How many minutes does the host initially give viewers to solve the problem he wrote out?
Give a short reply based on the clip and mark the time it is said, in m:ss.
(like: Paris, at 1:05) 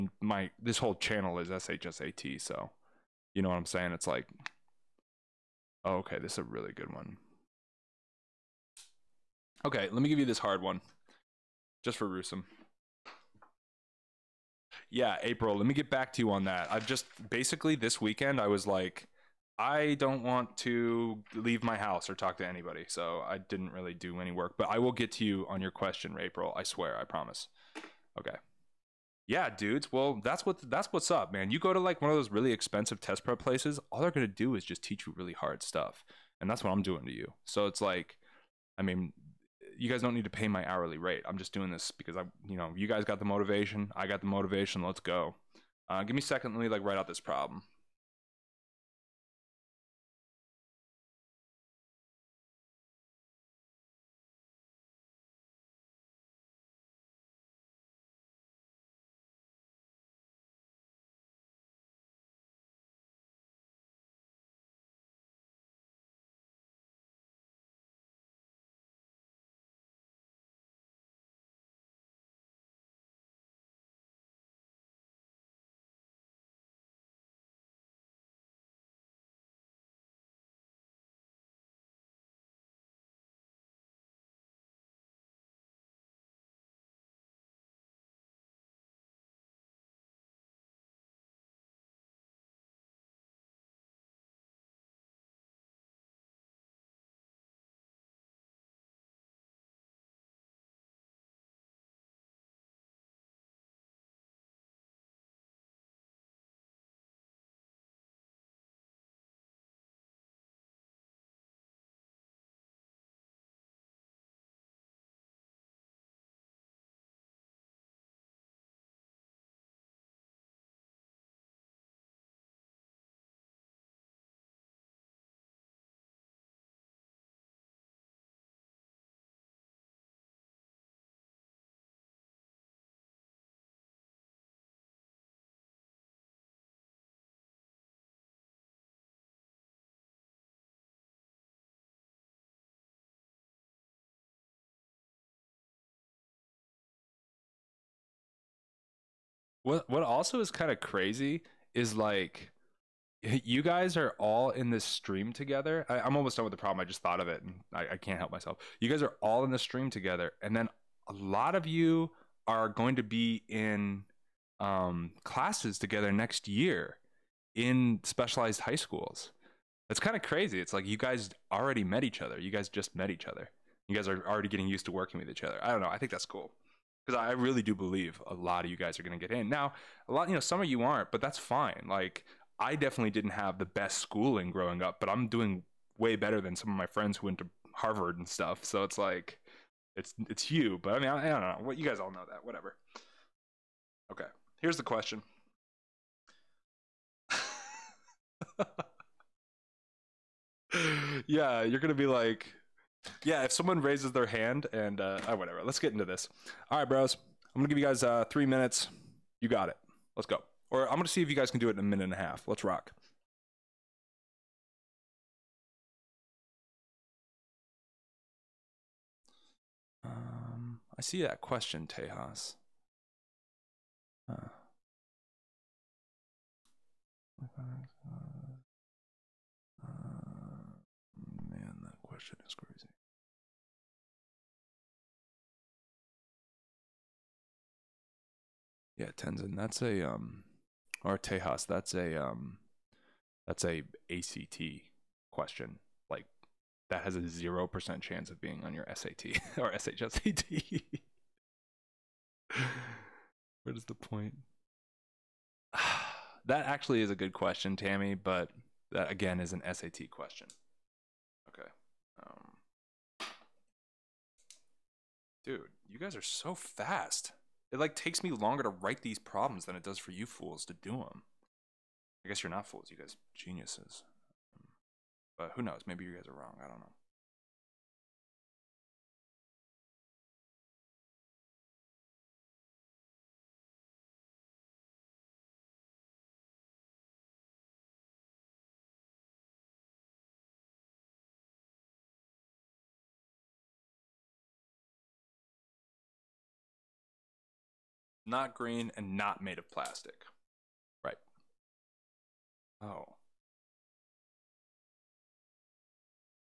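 3, at 3:28.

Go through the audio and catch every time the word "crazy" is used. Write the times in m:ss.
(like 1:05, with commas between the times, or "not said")
2:30, 2:50.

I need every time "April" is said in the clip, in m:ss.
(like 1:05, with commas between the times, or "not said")
0:15, 0:26.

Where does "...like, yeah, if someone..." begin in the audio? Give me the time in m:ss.
3:22.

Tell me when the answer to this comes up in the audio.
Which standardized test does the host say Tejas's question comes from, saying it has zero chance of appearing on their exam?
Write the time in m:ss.
4:04.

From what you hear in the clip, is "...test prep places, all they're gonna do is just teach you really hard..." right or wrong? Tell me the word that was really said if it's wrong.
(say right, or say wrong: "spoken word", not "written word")
right.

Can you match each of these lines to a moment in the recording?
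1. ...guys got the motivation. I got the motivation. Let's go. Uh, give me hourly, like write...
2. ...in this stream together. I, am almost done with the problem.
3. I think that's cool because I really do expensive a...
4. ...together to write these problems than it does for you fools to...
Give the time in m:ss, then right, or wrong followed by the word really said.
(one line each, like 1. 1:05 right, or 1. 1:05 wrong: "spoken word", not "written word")
1. 0:42 wrong: "secondly", not "hourly"
2. 2:34 right
3. 2:55 wrong: "believe", not "expensive"
4. 4:28 wrong: "longer", not "together".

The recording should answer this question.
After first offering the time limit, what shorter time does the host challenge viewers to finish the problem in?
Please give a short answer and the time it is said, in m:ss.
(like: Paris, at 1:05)
a minute and a half, at 3:31.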